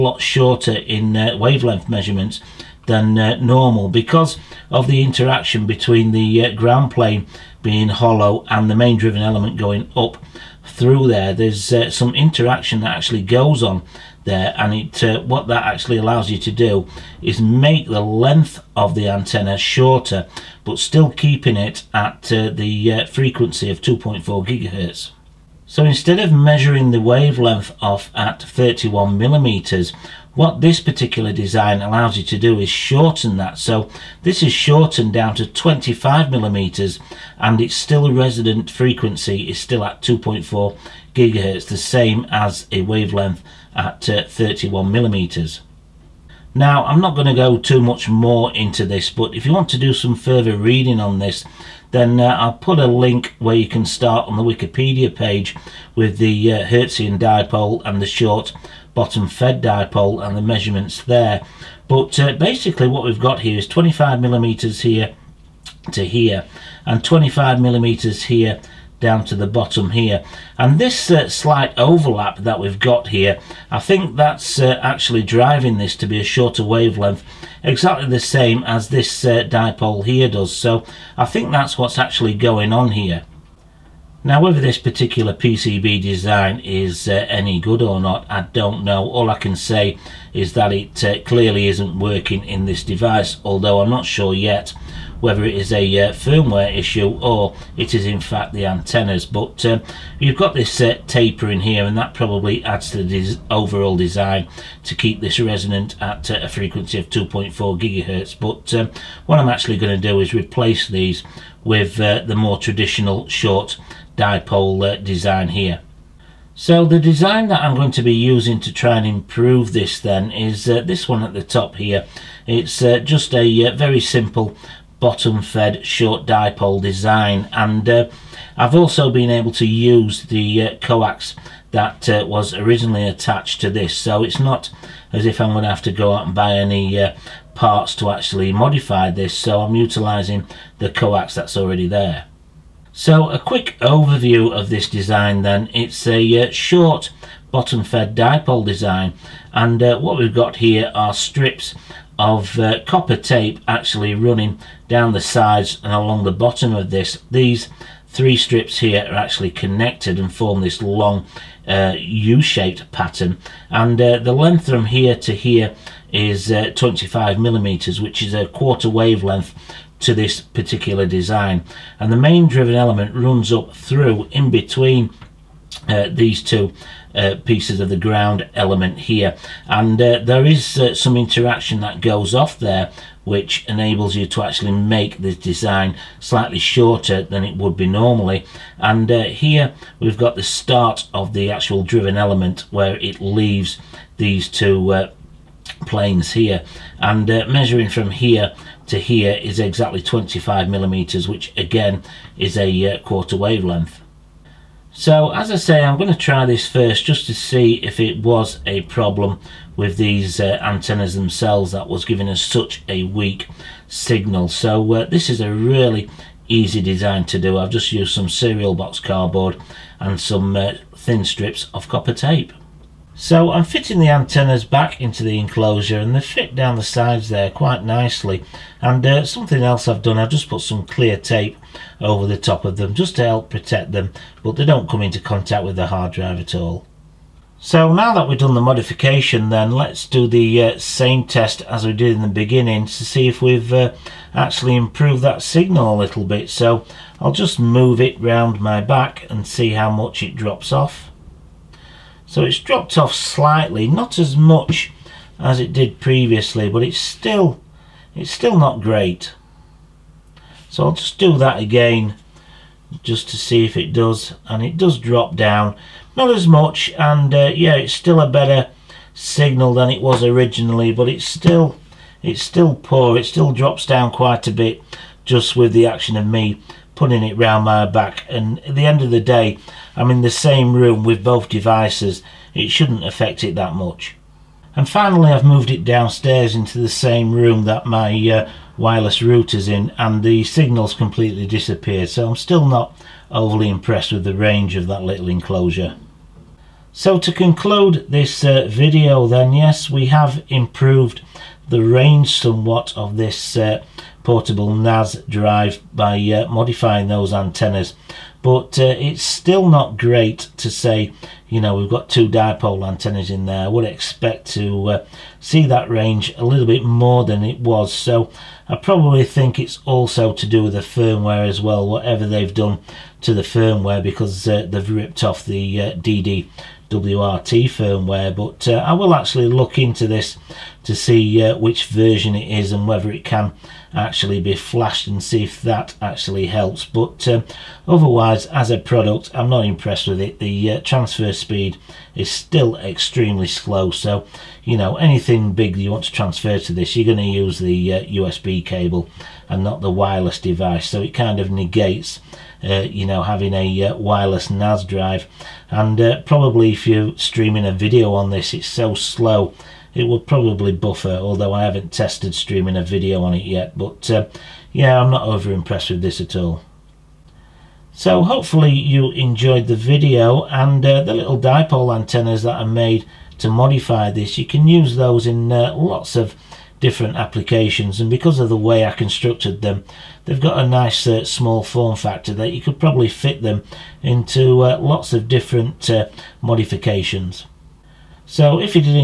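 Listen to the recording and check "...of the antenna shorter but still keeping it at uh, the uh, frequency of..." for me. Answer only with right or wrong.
right.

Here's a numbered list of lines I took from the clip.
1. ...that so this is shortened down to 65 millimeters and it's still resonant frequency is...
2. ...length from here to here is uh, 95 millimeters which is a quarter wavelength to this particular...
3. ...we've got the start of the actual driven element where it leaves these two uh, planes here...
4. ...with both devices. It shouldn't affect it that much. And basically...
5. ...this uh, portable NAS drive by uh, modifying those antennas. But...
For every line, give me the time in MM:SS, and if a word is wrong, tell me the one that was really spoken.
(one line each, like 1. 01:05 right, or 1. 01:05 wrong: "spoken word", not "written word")
1. 00:33 wrong: "25", not "65"
2. 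02:44 wrong: "25", not "95"
3. 03:10 right
4. 04:41 wrong: "finally", not "basically"
5. 05:03 right.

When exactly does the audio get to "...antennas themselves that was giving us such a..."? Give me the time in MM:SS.
03:30.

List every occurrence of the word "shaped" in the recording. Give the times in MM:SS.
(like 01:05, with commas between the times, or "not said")
02:41.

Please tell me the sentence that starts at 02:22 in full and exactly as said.
So a quick overview of this design then.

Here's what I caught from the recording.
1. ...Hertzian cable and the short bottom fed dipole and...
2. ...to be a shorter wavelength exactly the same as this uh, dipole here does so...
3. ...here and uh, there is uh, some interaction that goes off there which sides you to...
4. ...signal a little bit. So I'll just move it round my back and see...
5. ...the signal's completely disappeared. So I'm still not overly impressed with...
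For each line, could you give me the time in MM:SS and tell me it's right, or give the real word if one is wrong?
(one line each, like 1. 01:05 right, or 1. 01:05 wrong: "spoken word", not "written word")
1. 00:56 wrong: "dipole", not "cable"
2. 01:15 right
3. 02:58 wrong: "enables", not "sides"
4. 04:05 right
5. 04:50 right.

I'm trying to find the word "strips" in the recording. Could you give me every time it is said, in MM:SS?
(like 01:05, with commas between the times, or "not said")
02:31, 02:38, 03:41.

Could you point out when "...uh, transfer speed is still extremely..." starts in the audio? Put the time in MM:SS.
05:40.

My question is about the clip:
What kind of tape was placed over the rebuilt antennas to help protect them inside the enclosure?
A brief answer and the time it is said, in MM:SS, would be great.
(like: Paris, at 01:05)
clear tape, at 03:50.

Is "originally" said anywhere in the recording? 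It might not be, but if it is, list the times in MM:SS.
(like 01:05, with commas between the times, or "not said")
02:12, 04:30.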